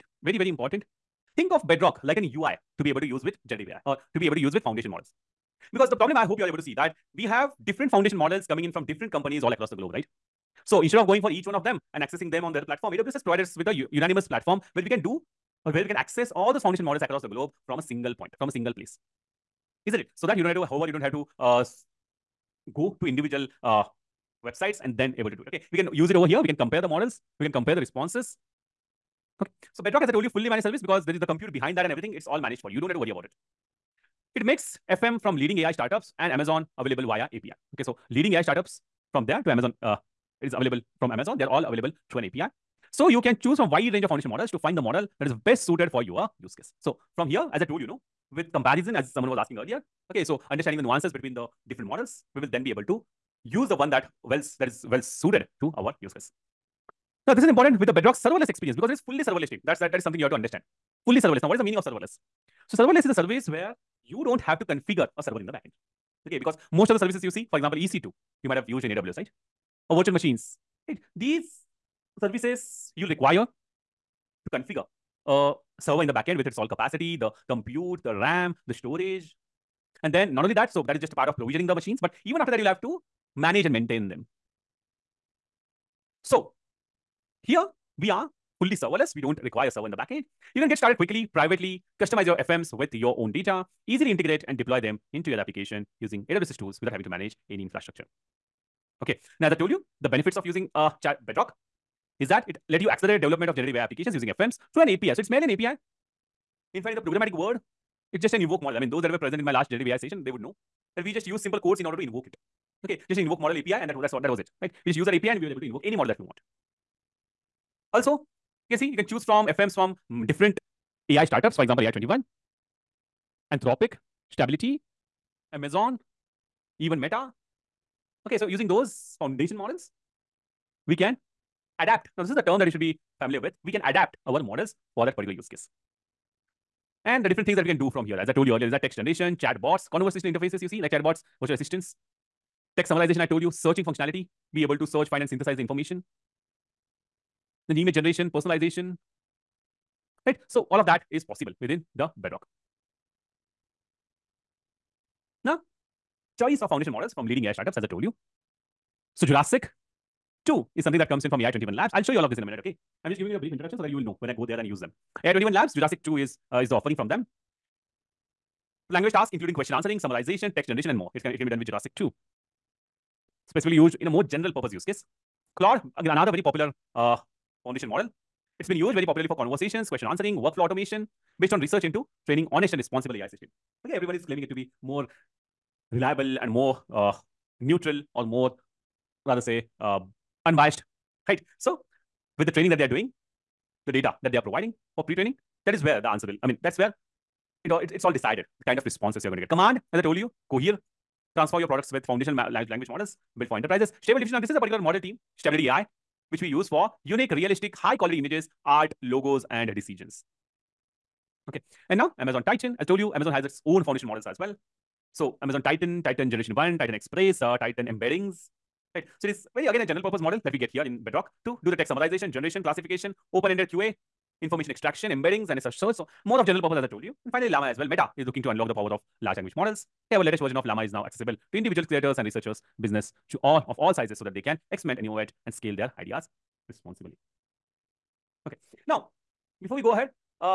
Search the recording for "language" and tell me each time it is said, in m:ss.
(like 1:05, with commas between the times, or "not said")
2:48, 3:22, 3:49.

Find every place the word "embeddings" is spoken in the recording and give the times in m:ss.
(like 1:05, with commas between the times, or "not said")
3:37, 3:45.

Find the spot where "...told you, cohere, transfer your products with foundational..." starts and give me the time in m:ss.
3:20.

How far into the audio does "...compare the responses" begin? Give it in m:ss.
0:27.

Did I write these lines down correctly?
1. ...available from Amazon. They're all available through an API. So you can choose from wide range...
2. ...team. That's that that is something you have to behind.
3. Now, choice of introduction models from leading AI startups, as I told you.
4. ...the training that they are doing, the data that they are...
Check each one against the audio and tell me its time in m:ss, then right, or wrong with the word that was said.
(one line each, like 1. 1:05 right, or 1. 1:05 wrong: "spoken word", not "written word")
1. 0:40 right
2. 0:59 wrong: "understand", not "behind"
3. 2:35 wrong: "foundation", not "introduction"
4. 3:12 right.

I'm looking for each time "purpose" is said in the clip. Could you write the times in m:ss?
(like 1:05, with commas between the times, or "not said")
2:54, 3:40, 3:46.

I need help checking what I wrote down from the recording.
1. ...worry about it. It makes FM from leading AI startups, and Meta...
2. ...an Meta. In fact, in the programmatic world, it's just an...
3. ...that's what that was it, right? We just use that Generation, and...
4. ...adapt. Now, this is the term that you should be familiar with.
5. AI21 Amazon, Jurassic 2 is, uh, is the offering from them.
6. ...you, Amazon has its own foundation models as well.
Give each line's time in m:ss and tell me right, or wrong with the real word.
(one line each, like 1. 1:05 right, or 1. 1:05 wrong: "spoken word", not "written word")
1. 0:32 wrong: "Amazon", not "Meta"
2. 1:45 wrong: "API", not "Meta"
3. 1:54 wrong: "API", not "Generation"
4. 2:11 right
5. 2:45 wrong: "Labs", not "Amazon"
6. 3:32 right.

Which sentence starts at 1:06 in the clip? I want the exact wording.
Okay, because most of the services you see, for example, EC2, you might have used in AWS, right?